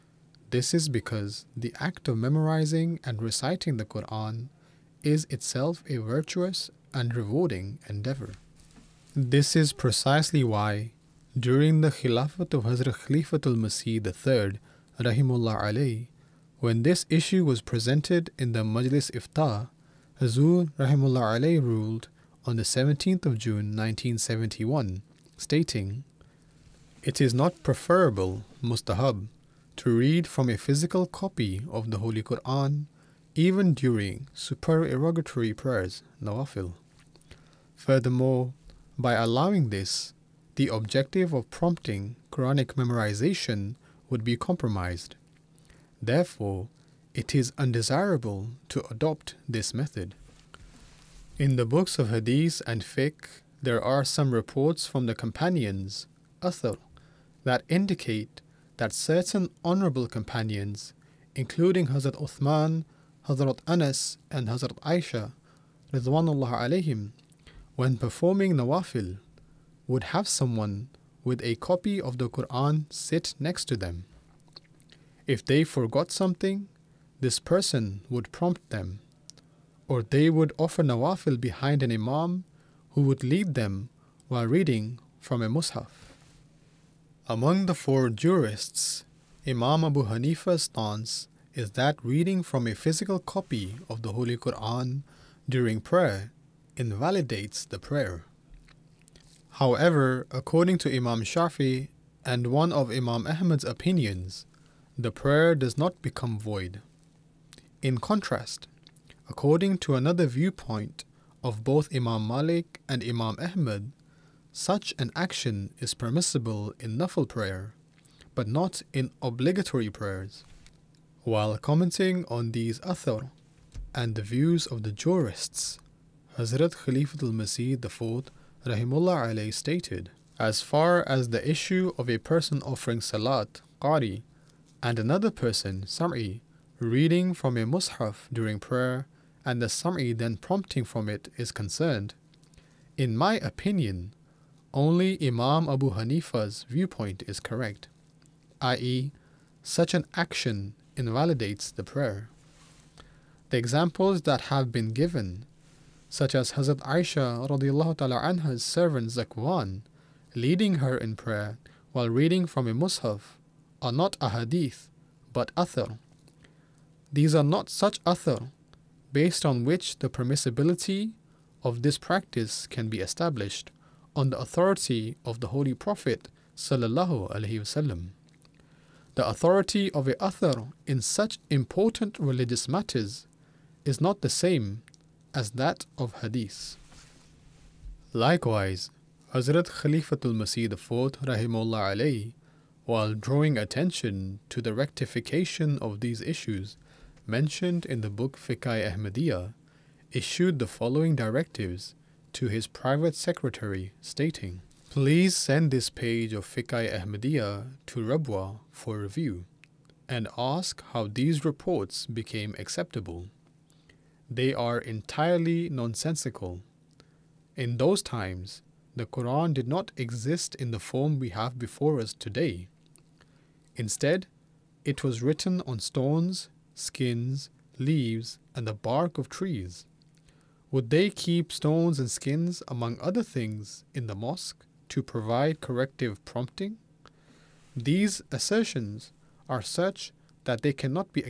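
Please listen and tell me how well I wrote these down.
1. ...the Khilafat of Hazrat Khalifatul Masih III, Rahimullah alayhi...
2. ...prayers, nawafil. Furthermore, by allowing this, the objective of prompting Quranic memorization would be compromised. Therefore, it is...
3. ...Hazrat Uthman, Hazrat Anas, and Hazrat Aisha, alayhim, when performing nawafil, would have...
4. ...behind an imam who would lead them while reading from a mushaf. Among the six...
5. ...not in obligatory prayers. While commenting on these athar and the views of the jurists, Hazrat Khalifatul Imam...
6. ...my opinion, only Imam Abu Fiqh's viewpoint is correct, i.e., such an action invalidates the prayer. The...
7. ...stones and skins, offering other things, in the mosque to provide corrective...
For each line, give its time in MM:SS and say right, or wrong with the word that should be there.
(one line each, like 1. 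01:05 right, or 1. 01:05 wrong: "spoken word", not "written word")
1. 00:11 right
2. 00:35 right
3. 01:01 right
4. 01:21 wrong: "four", not "six"
5. 01:58 wrong: "Masih", not "Imam"
6. 02:23 wrong: "Hanifa", not "Fiqh"
7. 03:51 wrong: "among", not "offering".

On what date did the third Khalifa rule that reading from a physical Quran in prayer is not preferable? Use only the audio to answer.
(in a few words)
17 June 1971.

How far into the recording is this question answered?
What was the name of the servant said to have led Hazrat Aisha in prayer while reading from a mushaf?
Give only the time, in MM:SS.
02:39.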